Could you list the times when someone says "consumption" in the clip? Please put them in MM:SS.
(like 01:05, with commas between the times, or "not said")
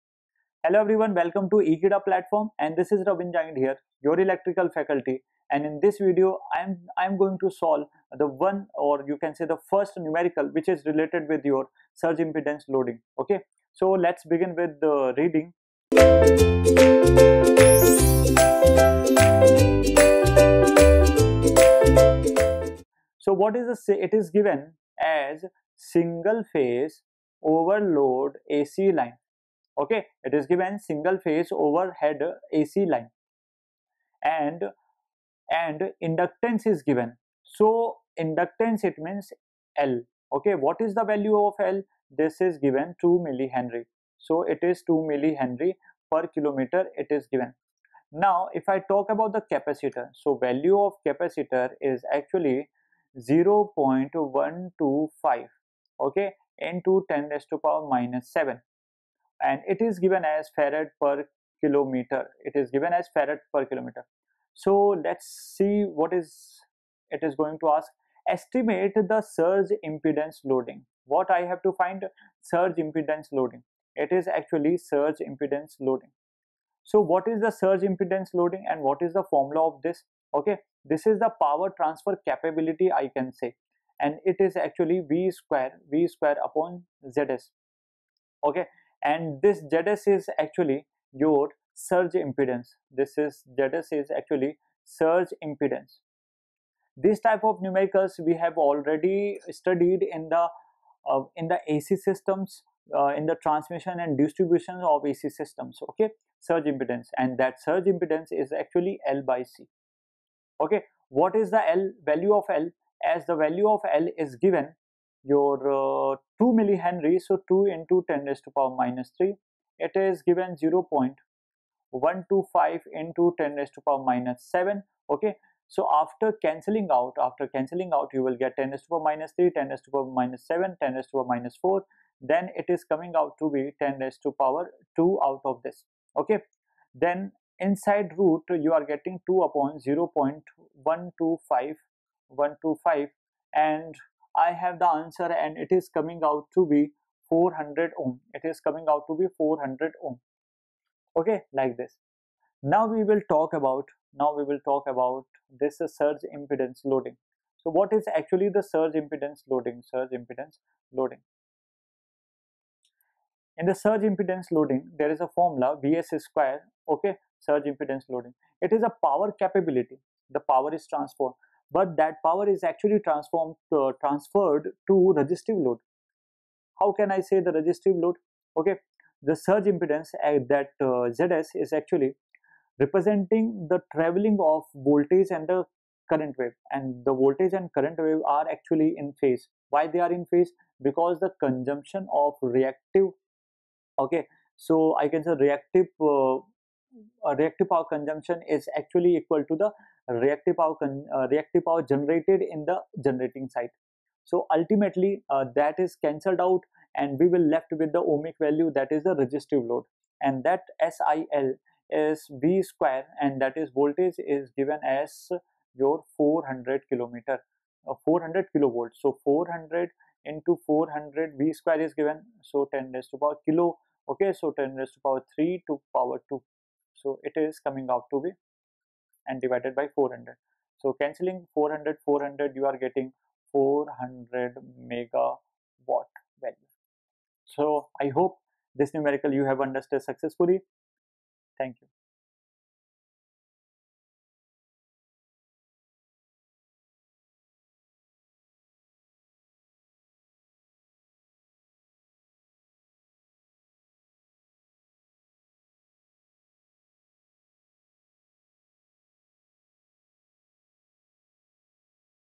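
03:11, 03:17.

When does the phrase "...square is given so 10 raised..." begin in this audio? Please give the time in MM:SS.
03:41.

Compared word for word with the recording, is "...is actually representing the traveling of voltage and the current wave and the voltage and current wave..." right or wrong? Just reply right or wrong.
right.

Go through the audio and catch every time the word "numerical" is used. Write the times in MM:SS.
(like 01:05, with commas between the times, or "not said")
00:09, 01:37, 03:58.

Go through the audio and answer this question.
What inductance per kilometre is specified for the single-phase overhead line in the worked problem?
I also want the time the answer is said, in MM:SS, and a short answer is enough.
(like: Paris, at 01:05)
2 millihenry per kilometer, at 00:44.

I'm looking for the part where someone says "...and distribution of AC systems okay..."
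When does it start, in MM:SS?
01:43.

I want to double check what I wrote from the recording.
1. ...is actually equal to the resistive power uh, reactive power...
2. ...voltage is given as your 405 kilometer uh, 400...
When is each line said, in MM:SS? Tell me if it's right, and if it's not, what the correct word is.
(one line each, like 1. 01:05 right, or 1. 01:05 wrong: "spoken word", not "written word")
1. 03:18 wrong: "reactive", not "resistive"
2. 03:33 wrong: "400", not "405".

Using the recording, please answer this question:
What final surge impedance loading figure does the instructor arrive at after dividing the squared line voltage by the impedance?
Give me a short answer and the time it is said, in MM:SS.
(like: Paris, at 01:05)
400 megawatt, at 03:53.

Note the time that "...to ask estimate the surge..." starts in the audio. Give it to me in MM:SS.
01:07.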